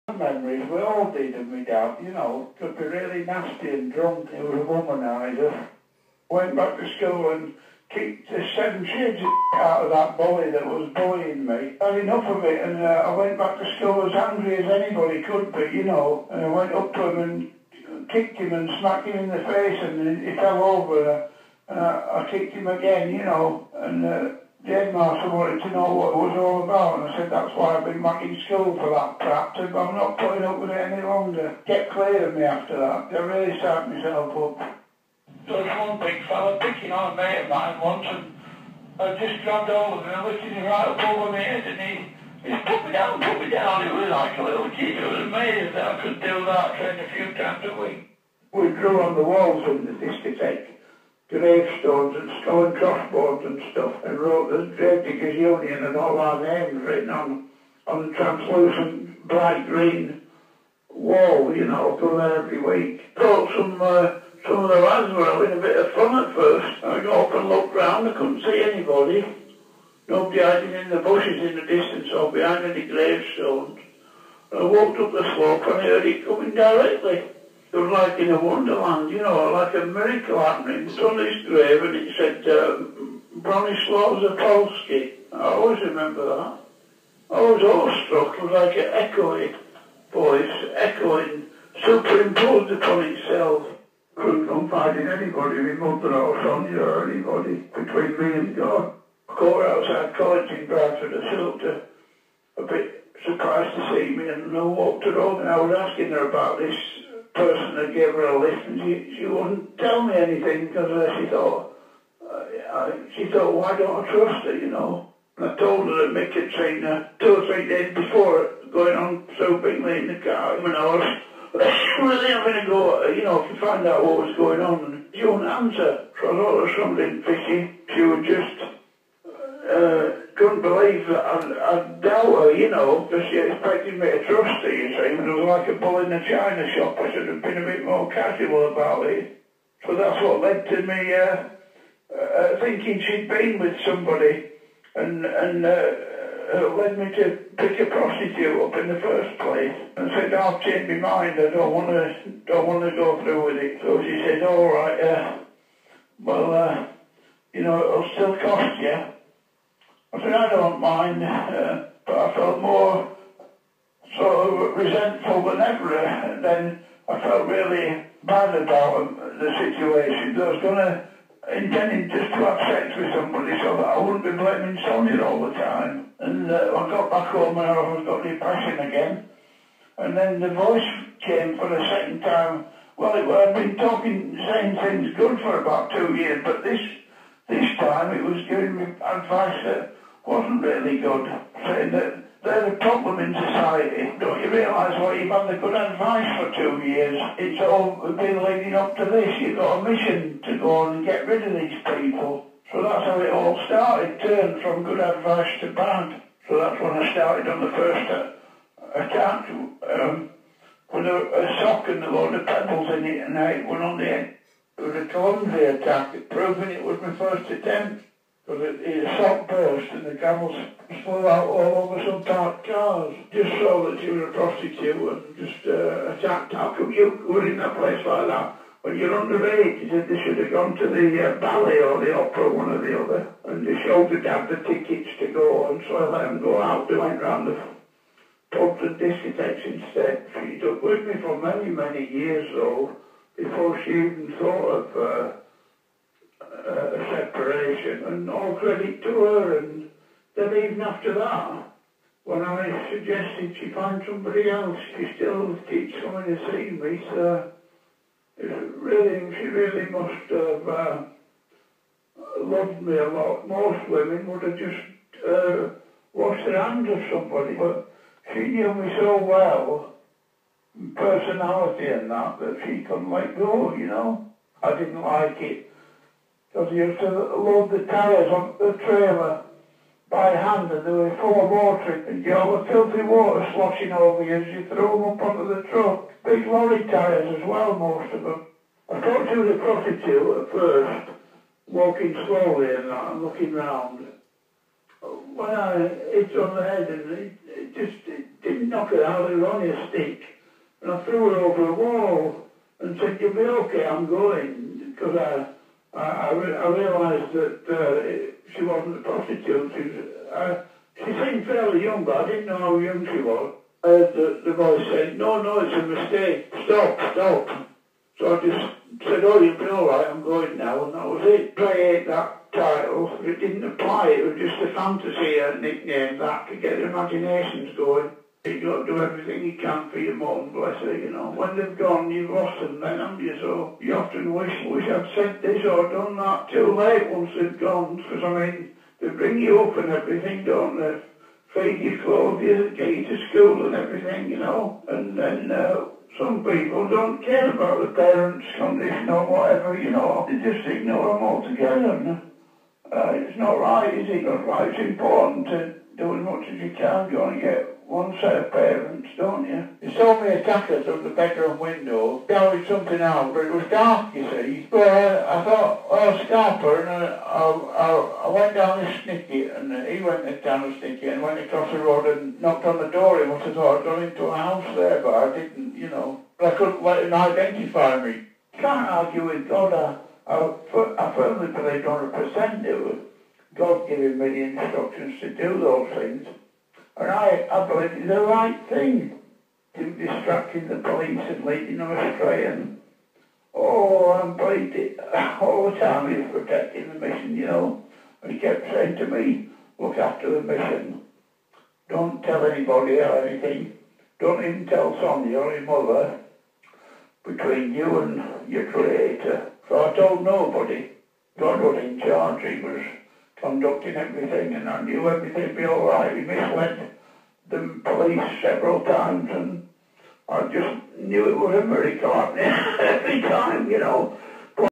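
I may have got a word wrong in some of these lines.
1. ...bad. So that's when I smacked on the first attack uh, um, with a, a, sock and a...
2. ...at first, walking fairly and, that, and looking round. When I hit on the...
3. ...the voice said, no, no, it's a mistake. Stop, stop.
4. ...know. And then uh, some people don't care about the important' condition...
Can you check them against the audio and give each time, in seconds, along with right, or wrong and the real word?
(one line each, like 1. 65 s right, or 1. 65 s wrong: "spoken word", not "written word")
1. 205 s wrong: "started", not "smacked"
2. 290 s wrong: "slowly", not "fairly"
3. 314 s right
4. 344 s wrong: "parents", not "important".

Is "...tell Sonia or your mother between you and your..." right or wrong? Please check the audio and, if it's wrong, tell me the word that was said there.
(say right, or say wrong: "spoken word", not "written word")
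right.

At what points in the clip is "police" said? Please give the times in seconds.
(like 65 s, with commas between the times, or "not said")
390 s, 417 s.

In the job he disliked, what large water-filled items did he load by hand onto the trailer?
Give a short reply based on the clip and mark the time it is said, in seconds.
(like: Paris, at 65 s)
Lorry tyres, at 286 s.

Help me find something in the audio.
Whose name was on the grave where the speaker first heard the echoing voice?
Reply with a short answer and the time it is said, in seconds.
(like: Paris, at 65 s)
Bronislaw Zapolski, at 83 s.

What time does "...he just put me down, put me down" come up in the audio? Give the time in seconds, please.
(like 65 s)
41 s.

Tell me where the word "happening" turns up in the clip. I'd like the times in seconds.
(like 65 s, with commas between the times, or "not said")
80 s, 422 s.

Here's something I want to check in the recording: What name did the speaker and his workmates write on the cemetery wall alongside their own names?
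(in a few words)
Gravediggers Union.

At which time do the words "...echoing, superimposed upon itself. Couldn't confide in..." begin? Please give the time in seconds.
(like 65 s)
90 s.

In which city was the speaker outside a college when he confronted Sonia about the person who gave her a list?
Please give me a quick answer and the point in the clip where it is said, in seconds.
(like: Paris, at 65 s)
Bradford, at 100 s.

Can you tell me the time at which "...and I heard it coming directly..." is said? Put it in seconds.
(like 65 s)
75 s.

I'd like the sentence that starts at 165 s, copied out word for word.
And then I felt really bad about the situation.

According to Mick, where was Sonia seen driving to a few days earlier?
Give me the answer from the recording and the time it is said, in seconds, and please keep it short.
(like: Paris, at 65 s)
Bingley, at 119 s.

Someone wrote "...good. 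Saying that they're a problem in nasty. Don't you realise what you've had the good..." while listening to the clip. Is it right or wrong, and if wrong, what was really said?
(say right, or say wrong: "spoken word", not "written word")
wrong: "society", not "nasty".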